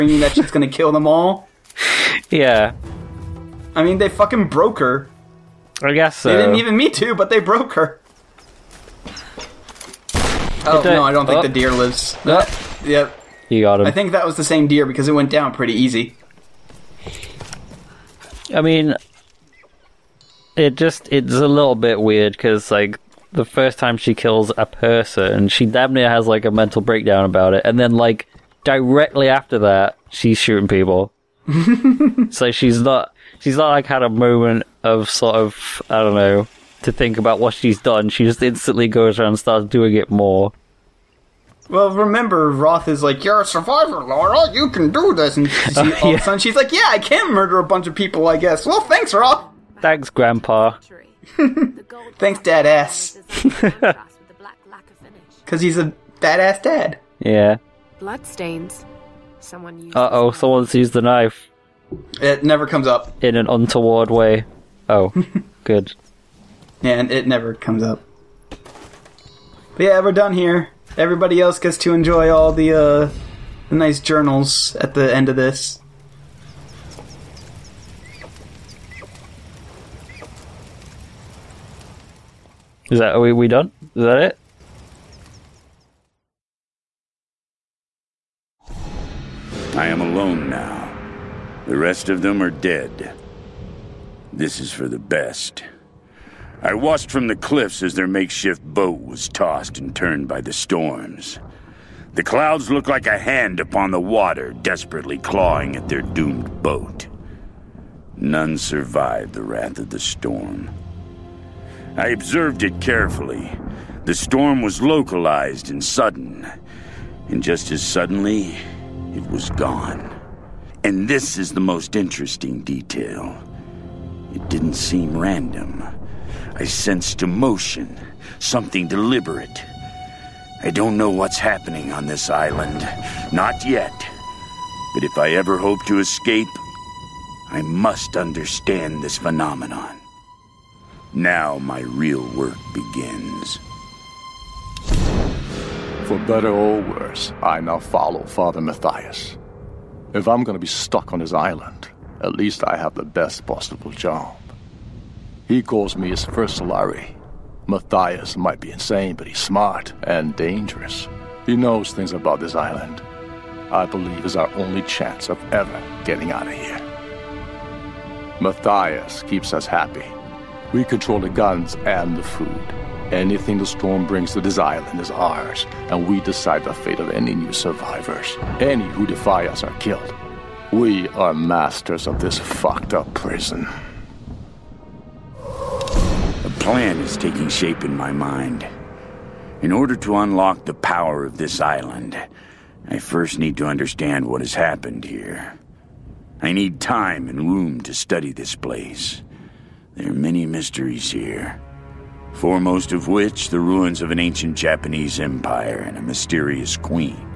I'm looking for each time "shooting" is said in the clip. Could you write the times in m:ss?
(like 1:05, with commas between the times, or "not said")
0:30.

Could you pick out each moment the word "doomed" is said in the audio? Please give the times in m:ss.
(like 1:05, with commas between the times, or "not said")
1:46.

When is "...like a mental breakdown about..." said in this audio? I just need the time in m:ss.
0:26.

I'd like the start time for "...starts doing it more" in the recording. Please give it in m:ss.
0:39.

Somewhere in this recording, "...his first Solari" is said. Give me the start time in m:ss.
2:36.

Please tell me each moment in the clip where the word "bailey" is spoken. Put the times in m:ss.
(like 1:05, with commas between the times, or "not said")
not said.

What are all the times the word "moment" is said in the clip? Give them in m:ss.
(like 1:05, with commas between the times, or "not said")
0:34.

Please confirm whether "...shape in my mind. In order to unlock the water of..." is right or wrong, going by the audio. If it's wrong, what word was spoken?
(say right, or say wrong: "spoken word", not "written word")
wrong: "power", not "water".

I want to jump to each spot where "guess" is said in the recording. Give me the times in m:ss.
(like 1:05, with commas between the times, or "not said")
0:05, 0:48.